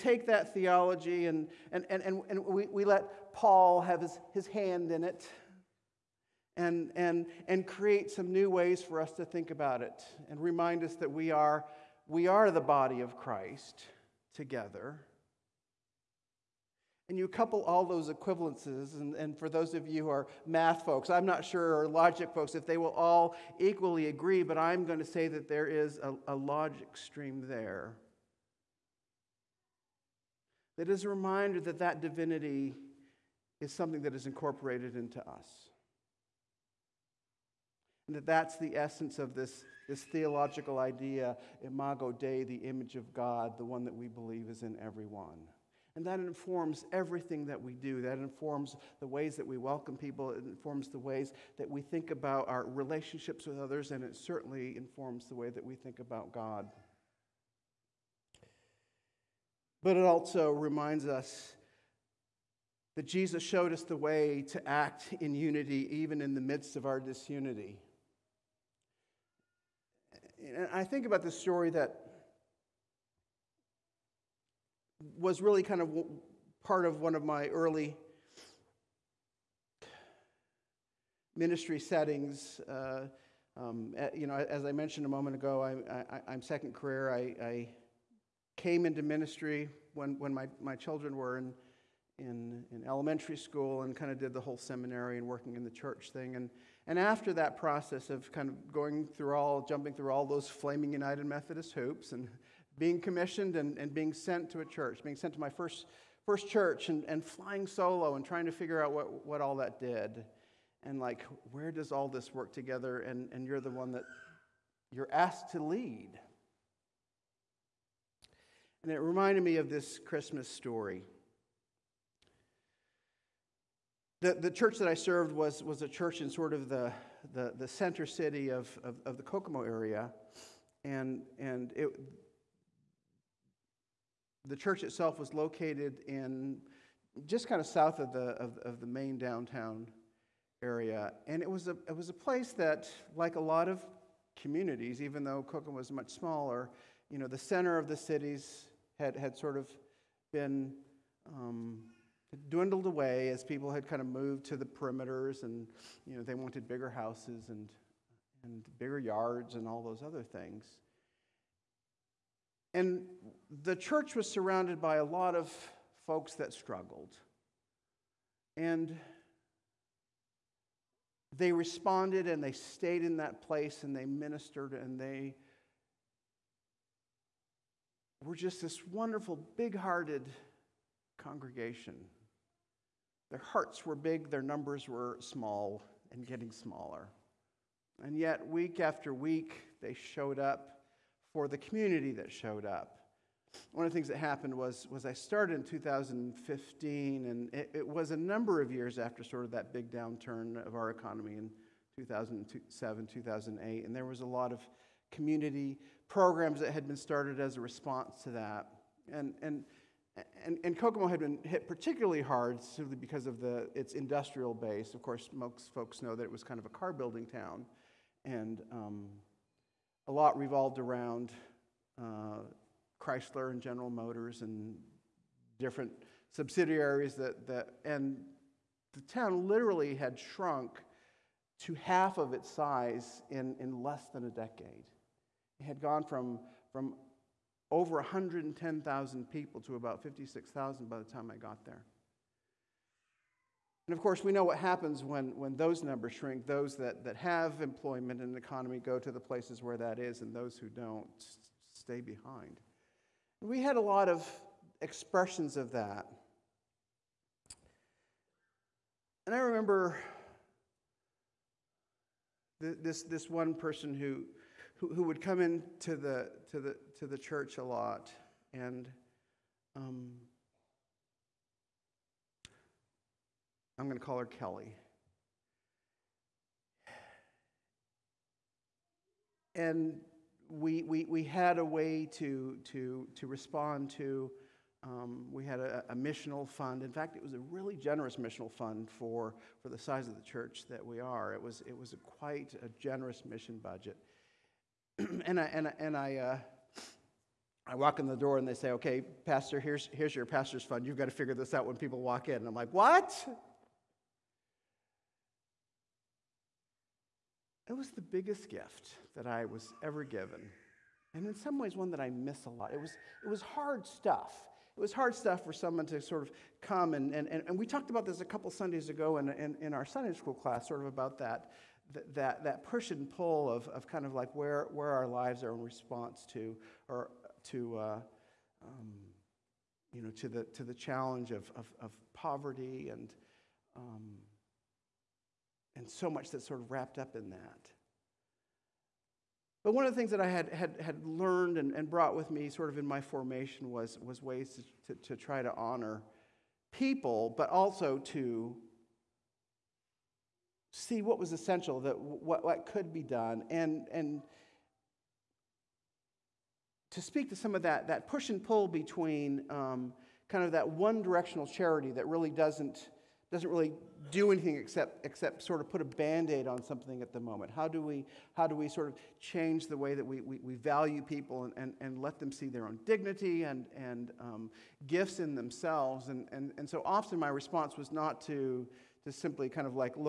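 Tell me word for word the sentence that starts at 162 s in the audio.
And the church was surrounded by a lot of folks that struggled.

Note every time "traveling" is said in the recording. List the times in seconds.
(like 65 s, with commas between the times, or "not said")
not said.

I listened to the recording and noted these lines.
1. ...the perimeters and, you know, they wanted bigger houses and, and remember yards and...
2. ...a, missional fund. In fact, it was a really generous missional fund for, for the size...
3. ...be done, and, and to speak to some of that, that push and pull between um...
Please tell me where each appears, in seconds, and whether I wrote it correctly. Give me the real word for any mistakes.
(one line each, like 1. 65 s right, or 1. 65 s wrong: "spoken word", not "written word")
1. 154 s wrong: "bigger", not "remember"
2. 285 s right
3. 352 s right.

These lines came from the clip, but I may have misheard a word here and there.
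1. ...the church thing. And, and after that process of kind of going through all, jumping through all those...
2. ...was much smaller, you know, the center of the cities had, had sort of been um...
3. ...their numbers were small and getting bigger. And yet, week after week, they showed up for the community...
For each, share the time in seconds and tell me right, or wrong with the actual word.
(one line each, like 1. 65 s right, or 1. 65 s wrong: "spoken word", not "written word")
1. 95 s right
2. 145 s right
3. 184 s wrong: "smaller", not "bigger".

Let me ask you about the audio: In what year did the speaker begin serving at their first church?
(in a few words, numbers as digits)
2015.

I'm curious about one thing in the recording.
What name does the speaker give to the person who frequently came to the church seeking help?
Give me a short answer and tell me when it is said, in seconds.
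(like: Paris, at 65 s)
Kelly, at 274 s.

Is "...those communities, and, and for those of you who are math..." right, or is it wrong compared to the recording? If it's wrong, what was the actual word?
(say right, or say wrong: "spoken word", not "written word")
wrong: "equivalences", not "communities".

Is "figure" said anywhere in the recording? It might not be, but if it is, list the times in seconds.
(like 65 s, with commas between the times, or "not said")
108 s, 301 s.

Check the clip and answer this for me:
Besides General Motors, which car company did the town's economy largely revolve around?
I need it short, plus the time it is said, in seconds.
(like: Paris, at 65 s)
Chrysler, at 223 s.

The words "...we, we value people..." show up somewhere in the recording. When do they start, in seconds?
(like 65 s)
370 s.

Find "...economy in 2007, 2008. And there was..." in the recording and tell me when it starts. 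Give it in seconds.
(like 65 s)
200 s.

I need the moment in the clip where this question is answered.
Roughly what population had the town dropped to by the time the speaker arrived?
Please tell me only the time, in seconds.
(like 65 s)
240 s.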